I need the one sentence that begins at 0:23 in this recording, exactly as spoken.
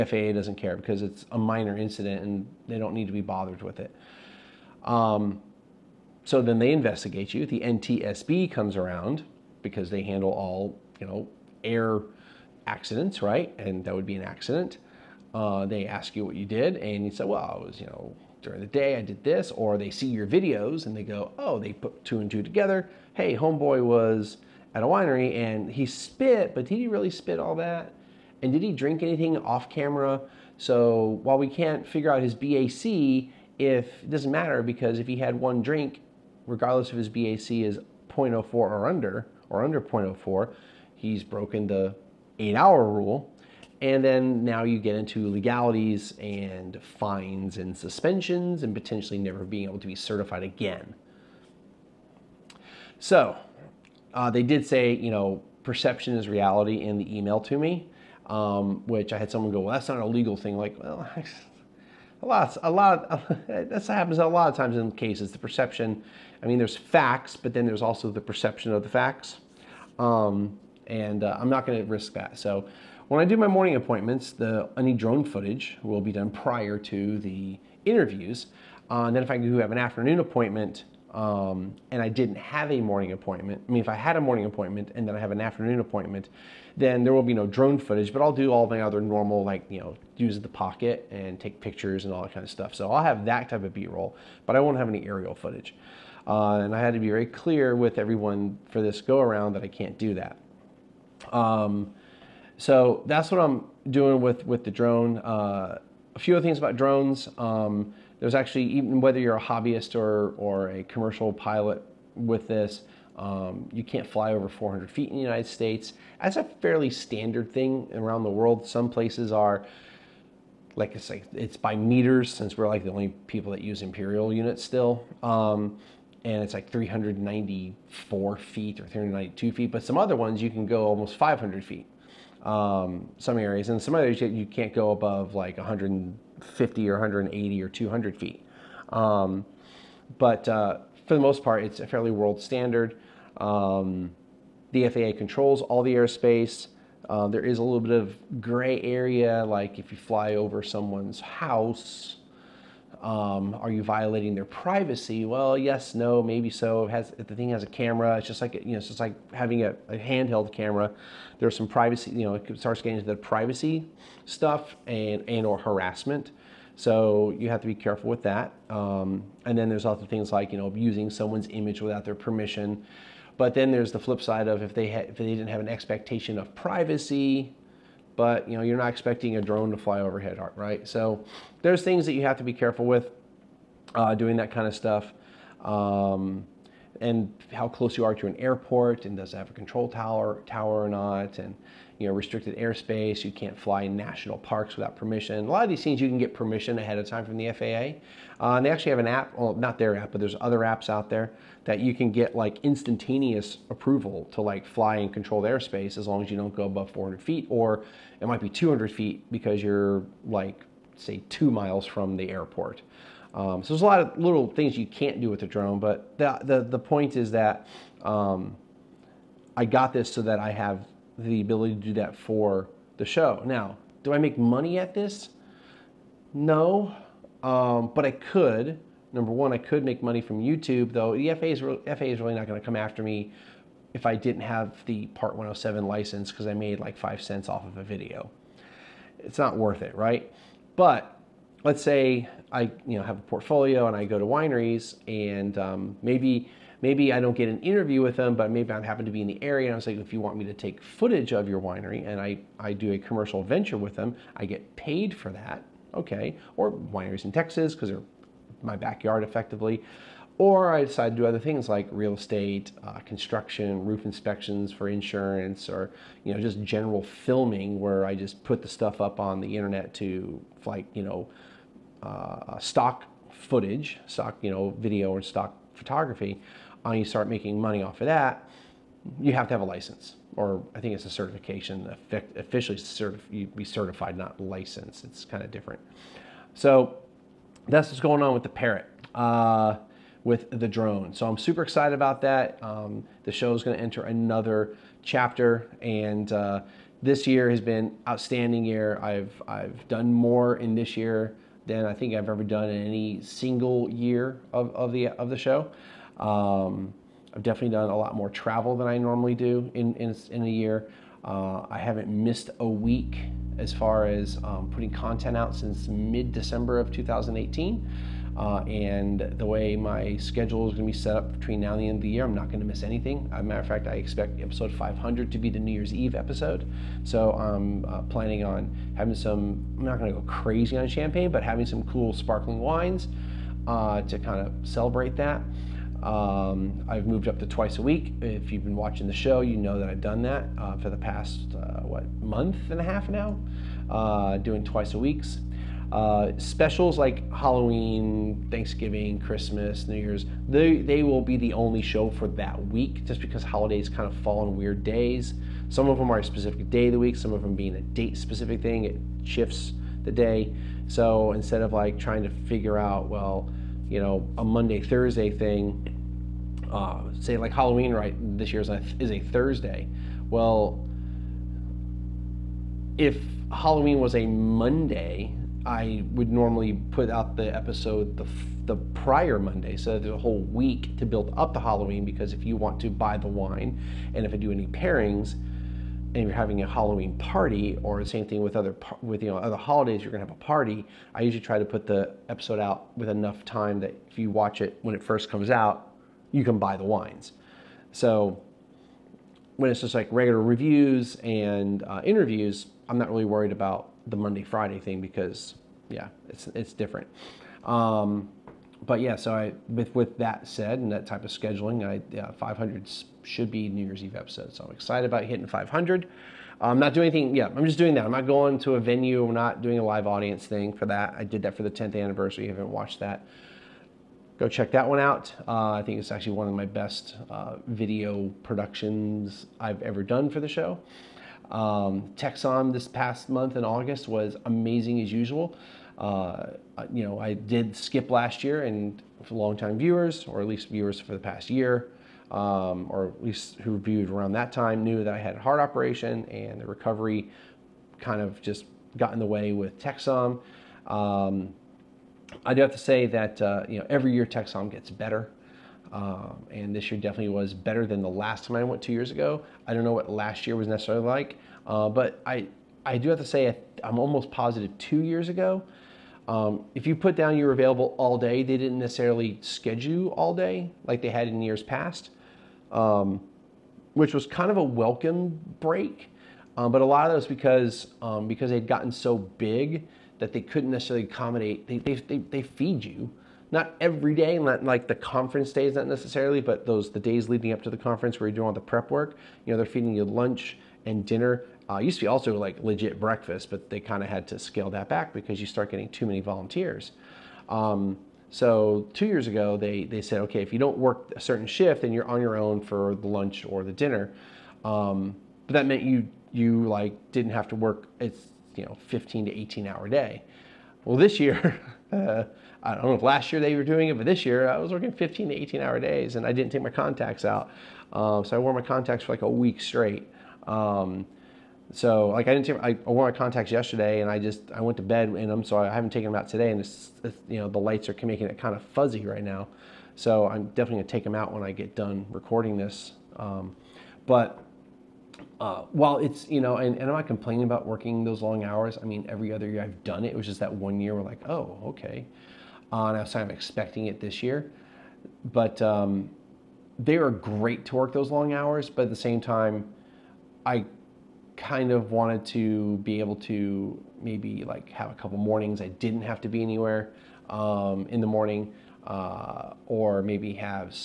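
Hey, homeboy was at a winery and he spit, but did he really spit all that?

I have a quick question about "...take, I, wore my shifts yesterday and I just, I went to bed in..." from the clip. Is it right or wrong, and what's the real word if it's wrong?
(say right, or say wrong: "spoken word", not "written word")
wrong: "contacts", not "shifts".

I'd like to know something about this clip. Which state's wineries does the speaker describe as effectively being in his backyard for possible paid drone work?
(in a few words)
Texas.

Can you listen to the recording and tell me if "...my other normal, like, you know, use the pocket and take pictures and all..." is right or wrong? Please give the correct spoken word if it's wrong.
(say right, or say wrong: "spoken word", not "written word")
right.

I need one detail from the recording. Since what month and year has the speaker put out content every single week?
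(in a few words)
December 2018.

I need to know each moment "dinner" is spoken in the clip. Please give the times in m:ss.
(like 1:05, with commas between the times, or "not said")
8:11, 8:23.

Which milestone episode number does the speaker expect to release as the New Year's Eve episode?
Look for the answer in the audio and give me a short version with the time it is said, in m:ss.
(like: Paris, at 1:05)
500, at 5:24.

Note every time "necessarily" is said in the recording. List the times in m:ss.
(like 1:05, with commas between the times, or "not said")
7:40, 7:48, 8:00, 8:05.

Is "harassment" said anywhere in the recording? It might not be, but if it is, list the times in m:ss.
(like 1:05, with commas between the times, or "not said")
2:45.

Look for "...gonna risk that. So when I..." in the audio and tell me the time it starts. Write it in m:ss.
1:11.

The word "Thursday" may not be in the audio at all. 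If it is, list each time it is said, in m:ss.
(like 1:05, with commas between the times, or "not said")
6:04, 6:09.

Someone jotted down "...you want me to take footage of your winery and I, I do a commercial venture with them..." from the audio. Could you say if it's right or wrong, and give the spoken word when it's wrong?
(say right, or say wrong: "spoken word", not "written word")
right.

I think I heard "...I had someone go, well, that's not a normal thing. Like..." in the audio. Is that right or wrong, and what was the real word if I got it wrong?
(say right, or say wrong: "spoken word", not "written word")
wrong: "legal", not "normal".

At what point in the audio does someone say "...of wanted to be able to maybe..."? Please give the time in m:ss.
9:11.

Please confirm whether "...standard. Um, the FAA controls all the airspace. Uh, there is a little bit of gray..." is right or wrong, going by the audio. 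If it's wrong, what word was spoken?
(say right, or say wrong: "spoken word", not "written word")
right.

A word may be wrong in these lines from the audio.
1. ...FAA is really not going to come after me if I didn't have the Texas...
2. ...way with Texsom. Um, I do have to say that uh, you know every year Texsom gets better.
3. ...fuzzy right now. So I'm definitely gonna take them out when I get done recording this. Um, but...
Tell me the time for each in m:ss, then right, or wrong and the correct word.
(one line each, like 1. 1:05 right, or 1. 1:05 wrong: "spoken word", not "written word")
1. 3:51 wrong: "Part", not "Texas"
2. 7:29 right
3. 8:48 right.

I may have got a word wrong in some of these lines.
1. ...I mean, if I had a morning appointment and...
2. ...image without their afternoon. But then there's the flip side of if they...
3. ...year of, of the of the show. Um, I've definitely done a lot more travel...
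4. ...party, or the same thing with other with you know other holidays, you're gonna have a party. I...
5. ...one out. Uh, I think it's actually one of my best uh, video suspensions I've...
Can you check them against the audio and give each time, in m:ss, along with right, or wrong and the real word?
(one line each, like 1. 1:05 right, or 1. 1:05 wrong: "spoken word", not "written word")
1. 1:23 right
2. 2:51 wrong: "permission", not "afternoon"
3. 5:03 right
4. 6:27 right
5. 7:04 wrong: "productions", not "suspensions".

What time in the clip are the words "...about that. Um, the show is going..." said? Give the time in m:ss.
4:51.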